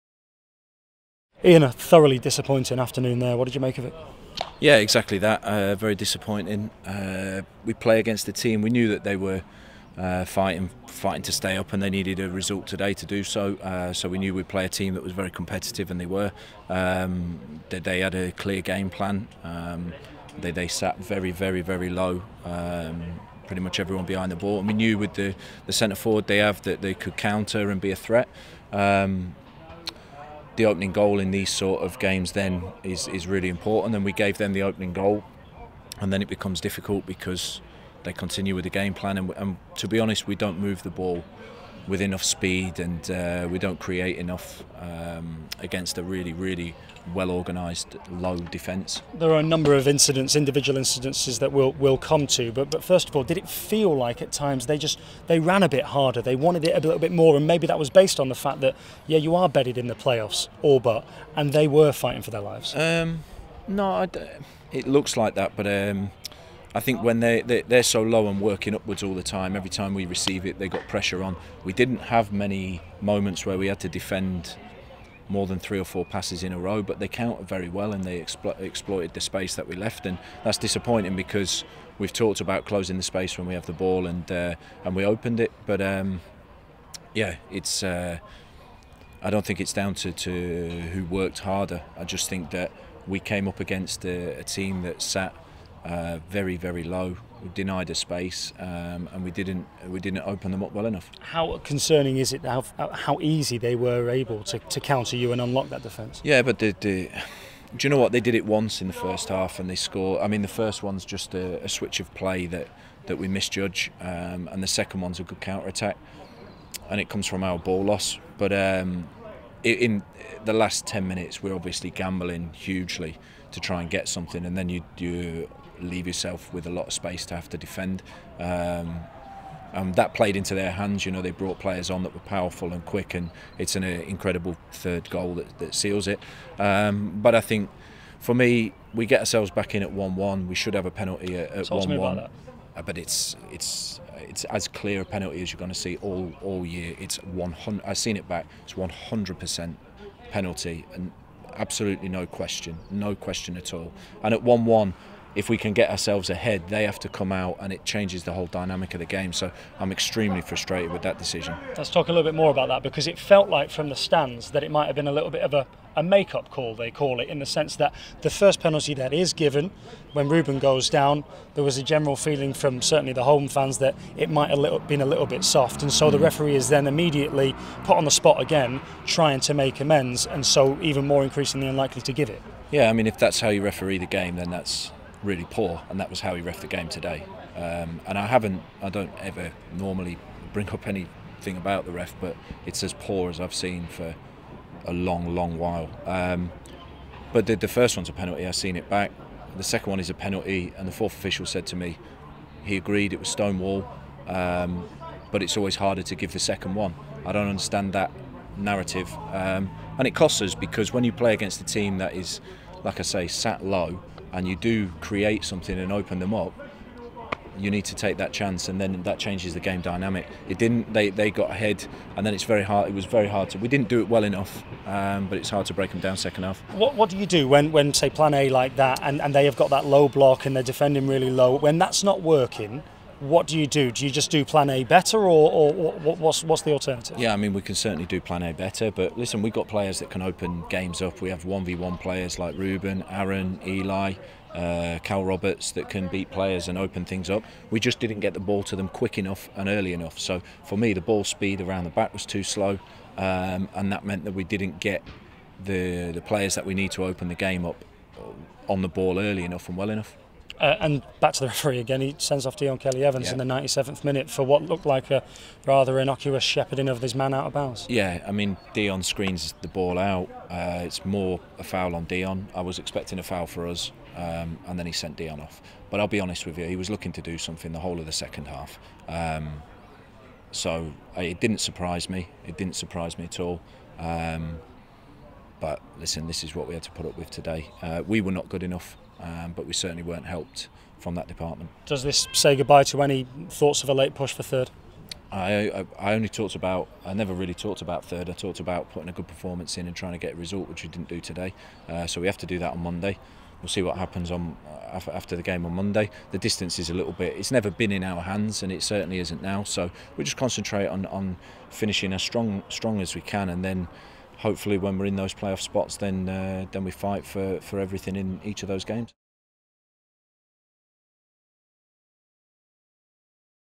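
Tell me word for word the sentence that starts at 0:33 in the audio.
And we gave them the opening goal, and then it becomes difficult because they continue with the game plan.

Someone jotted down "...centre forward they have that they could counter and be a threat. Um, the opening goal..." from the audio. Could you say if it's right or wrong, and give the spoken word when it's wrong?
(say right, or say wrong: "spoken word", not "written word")
right.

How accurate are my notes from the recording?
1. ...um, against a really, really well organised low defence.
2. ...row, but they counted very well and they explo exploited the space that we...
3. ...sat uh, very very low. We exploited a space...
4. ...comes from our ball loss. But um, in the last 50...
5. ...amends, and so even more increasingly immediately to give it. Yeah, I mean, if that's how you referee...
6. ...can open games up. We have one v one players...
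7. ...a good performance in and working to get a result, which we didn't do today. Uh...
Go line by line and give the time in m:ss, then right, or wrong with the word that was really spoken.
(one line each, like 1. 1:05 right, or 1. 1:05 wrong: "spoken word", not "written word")
1. 0:44 right
2. 1:16 right
3. 1:35 wrong: "denied", not "exploited"
4. 1:57 wrong: "10", not "50"
5. 2:59 wrong: "unlikely", not "immediately"
6. 4:00 right
7. 4:59 wrong: "trying", not "working".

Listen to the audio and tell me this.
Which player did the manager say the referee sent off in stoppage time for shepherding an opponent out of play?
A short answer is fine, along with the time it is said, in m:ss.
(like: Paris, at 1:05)
Dion Kelly Evans, at 4:22.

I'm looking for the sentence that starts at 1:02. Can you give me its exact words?
Um, no, it looks like that, but.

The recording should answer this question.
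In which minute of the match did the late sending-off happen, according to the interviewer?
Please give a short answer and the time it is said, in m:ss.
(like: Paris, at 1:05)
97th, at 4:23.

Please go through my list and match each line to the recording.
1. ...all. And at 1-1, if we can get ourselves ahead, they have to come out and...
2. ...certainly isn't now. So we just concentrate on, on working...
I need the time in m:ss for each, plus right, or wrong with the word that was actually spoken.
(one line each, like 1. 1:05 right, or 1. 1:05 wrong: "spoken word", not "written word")
1. 2:33 right
2. 5:08 wrong: "finishing", not "working".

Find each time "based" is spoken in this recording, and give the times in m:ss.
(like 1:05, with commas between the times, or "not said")
0:57.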